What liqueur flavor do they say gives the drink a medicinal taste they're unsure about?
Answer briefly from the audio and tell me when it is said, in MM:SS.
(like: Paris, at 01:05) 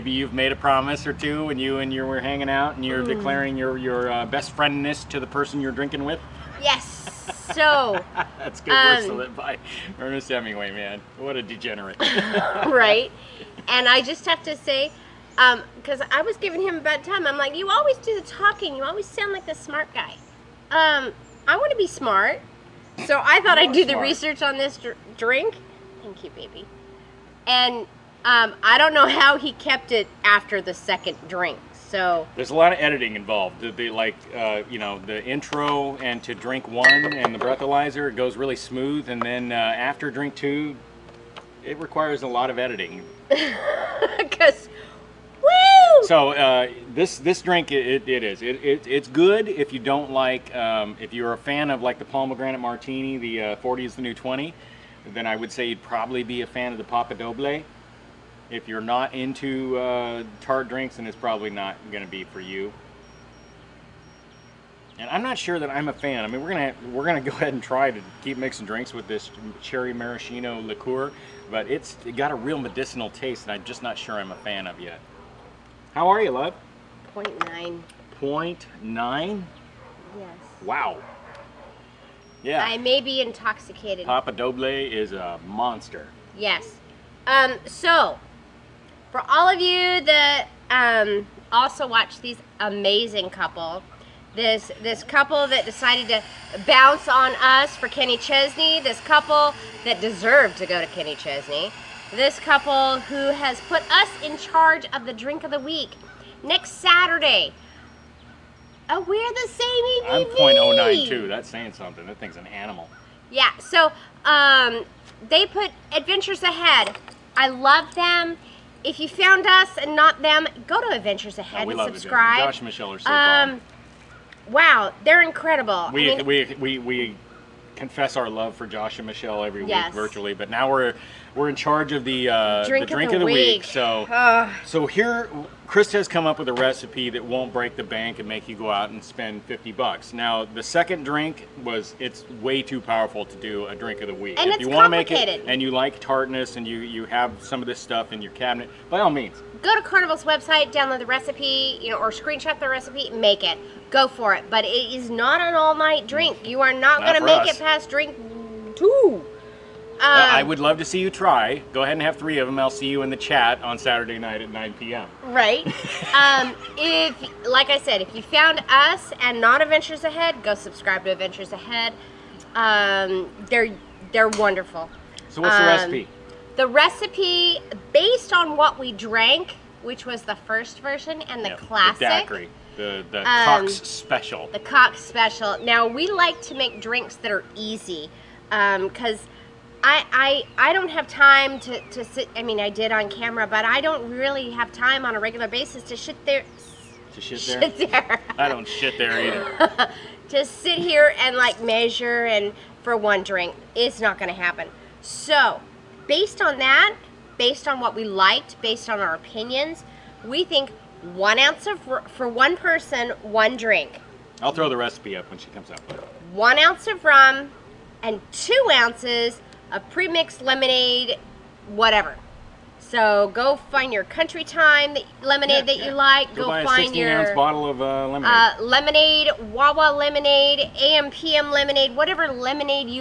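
cherry maraschino, at 01:09.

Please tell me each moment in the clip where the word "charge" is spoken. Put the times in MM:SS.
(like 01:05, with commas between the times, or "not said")
01:44, 02:11.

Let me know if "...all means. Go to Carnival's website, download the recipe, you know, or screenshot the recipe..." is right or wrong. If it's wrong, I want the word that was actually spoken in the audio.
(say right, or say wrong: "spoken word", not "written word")
right.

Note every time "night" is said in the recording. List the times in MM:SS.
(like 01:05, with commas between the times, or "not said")
02:35, 02:44.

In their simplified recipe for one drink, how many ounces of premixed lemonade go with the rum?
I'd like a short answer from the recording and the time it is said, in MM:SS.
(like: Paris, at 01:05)
2 ounces, at 03:38.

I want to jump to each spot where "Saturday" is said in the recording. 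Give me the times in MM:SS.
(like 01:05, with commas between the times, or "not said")
01:46, 02:43.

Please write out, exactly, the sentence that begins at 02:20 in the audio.
Now, the second drink was it's way too powerful to do a drink of the week.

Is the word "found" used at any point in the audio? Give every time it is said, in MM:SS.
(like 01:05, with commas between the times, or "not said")
01:59, 02:48.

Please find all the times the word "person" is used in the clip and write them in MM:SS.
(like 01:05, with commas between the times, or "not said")
00:05, 03:32.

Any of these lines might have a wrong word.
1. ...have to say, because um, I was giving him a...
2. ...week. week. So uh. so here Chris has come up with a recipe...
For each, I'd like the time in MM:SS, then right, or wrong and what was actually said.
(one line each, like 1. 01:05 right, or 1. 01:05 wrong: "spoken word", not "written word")
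1. 00:14 right
2. 02:13 right.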